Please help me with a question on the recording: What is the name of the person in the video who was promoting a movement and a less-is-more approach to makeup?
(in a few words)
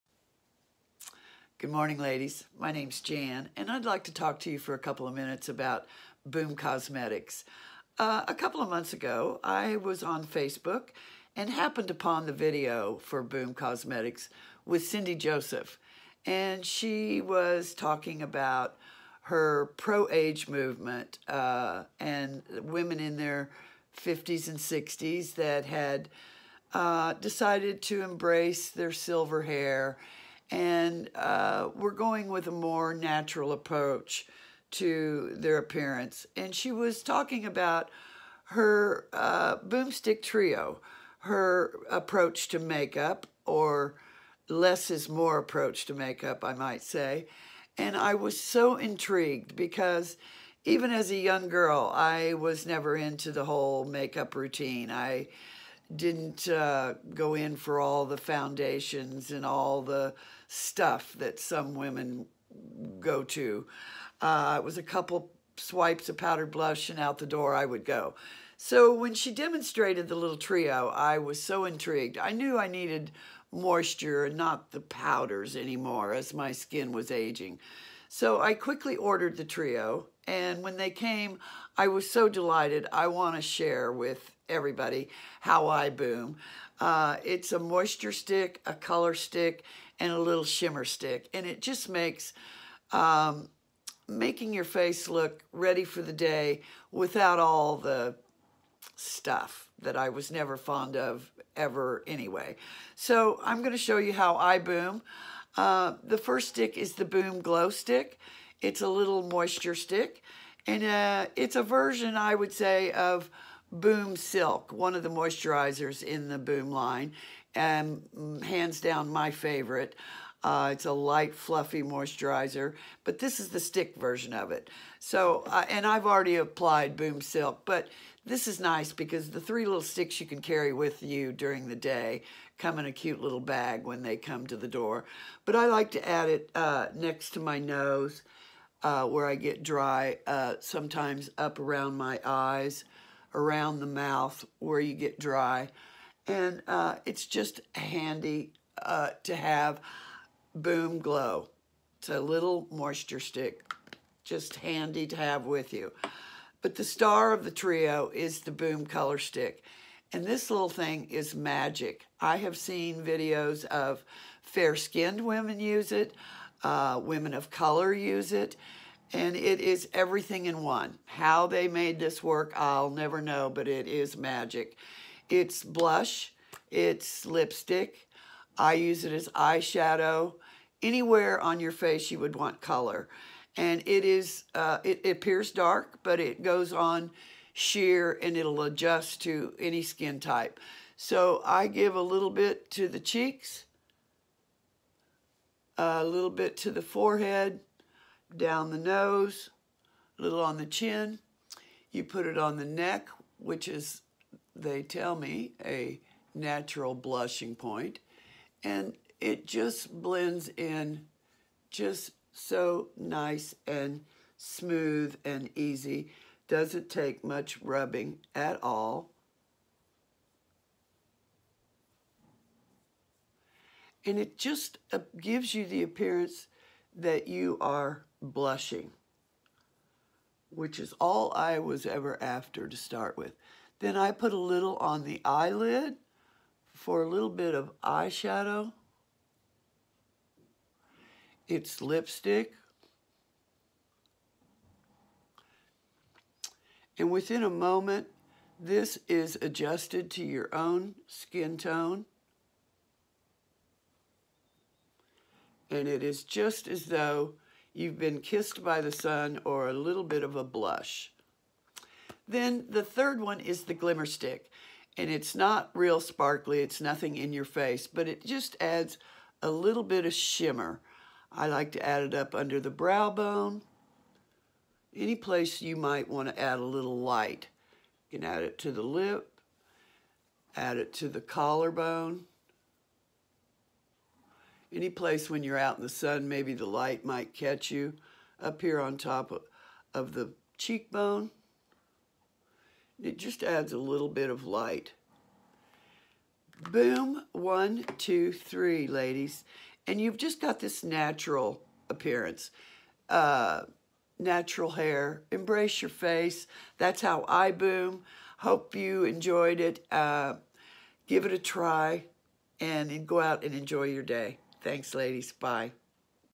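Cindy Joseph.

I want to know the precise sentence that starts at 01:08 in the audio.
So when she demonstrated the little trio, I was so intrigued.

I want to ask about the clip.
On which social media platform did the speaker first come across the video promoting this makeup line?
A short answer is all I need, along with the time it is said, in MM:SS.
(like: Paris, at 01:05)
Facebook, at 00:10.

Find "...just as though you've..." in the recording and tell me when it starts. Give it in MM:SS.
04:16.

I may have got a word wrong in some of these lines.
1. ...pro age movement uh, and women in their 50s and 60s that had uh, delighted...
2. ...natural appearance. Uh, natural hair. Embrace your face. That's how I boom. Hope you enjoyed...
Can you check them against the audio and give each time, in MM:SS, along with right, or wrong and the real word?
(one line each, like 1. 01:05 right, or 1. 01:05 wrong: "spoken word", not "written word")
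1. 00:19 wrong: "decided", not "delighted"
2. 05:00 right.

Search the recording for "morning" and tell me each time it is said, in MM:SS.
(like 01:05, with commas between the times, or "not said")
00:01.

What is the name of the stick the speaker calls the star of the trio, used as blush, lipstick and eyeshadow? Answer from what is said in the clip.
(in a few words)
Boom Color Stick.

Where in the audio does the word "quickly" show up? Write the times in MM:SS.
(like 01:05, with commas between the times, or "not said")
01:18.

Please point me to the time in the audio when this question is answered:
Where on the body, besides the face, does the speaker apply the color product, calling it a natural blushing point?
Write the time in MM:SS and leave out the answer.
03:22.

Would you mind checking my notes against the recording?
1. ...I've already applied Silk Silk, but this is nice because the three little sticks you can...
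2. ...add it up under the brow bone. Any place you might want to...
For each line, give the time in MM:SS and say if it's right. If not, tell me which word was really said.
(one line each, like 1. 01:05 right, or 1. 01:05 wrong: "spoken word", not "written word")
1. 02:05 wrong: "Boom", not "Silk"
2. 04:31 right.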